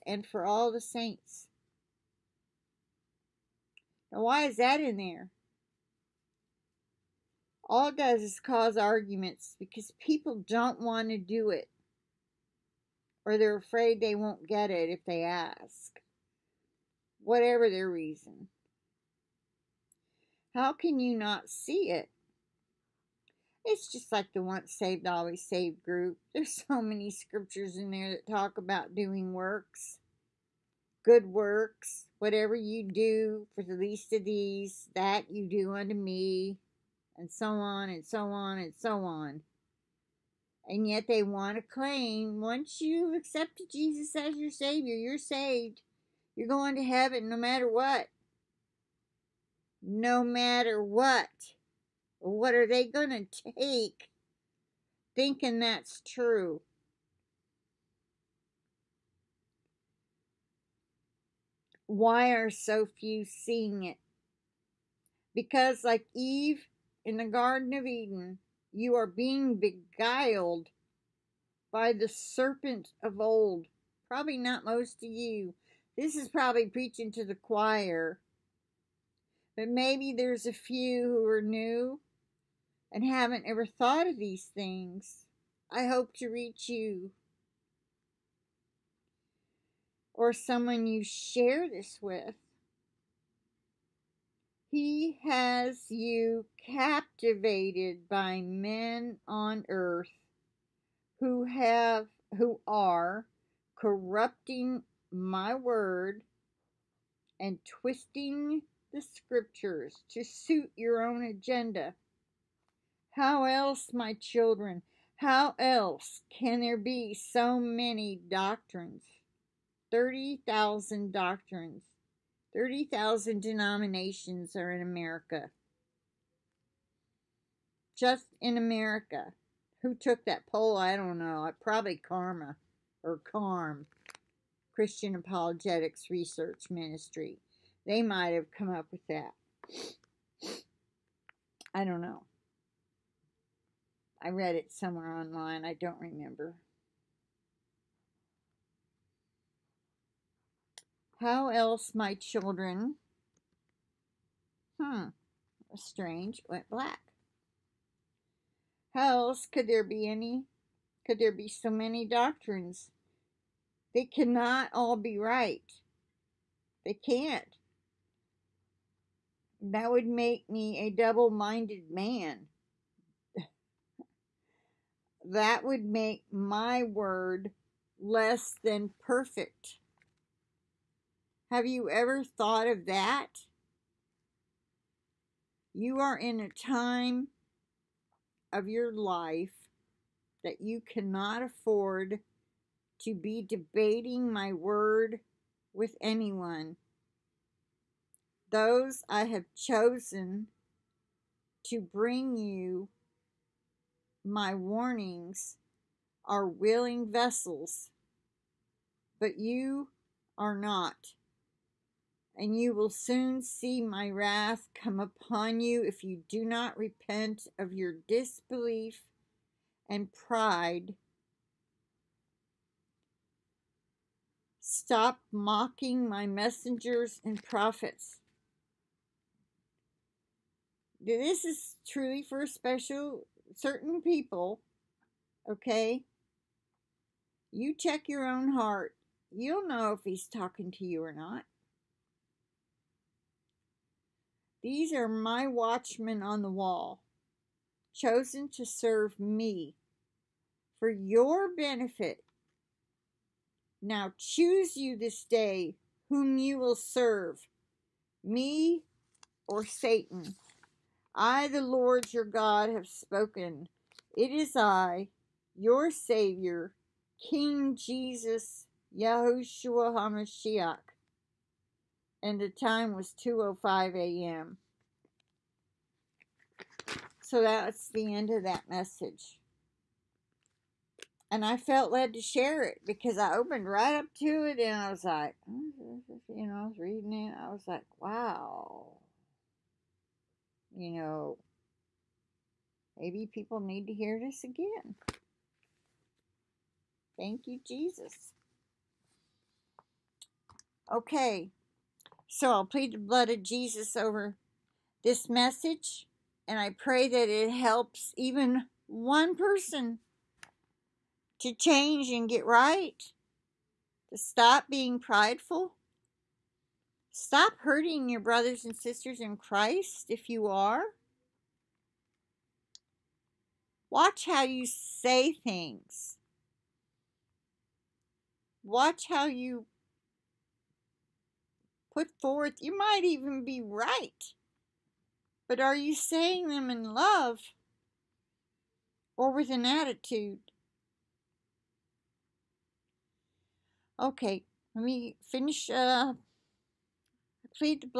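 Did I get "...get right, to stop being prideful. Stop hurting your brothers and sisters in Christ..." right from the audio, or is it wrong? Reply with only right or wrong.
right.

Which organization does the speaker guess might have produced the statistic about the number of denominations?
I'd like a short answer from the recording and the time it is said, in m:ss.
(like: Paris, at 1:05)
Christian Apologetics Research Ministry, at 2:14.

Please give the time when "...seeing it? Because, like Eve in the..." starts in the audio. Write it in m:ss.
1:03.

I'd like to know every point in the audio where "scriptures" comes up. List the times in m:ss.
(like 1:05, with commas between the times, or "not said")
0:27, 1:49.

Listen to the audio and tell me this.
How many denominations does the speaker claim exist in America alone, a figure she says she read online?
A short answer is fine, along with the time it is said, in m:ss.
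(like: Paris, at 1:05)
30,000, at 2:02.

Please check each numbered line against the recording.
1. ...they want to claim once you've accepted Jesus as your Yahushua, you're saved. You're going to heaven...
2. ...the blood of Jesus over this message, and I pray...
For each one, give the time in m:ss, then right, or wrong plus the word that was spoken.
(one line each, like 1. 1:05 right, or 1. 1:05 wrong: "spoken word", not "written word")
1. 0:41 wrong: "Savior", not "Yahushua"
2. 5:02 right.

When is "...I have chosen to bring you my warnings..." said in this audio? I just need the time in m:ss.
3:19.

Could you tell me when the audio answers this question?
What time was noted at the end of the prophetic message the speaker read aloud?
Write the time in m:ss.
4:33.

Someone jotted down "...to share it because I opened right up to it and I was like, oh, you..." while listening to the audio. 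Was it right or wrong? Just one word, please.
right.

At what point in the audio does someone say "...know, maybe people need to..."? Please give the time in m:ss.
4:50.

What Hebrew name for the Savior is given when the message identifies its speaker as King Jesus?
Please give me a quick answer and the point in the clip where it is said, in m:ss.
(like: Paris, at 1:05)
Yahushua HaMashiach, at 4:28.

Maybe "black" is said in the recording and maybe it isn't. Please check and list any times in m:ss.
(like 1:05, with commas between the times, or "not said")
2:36.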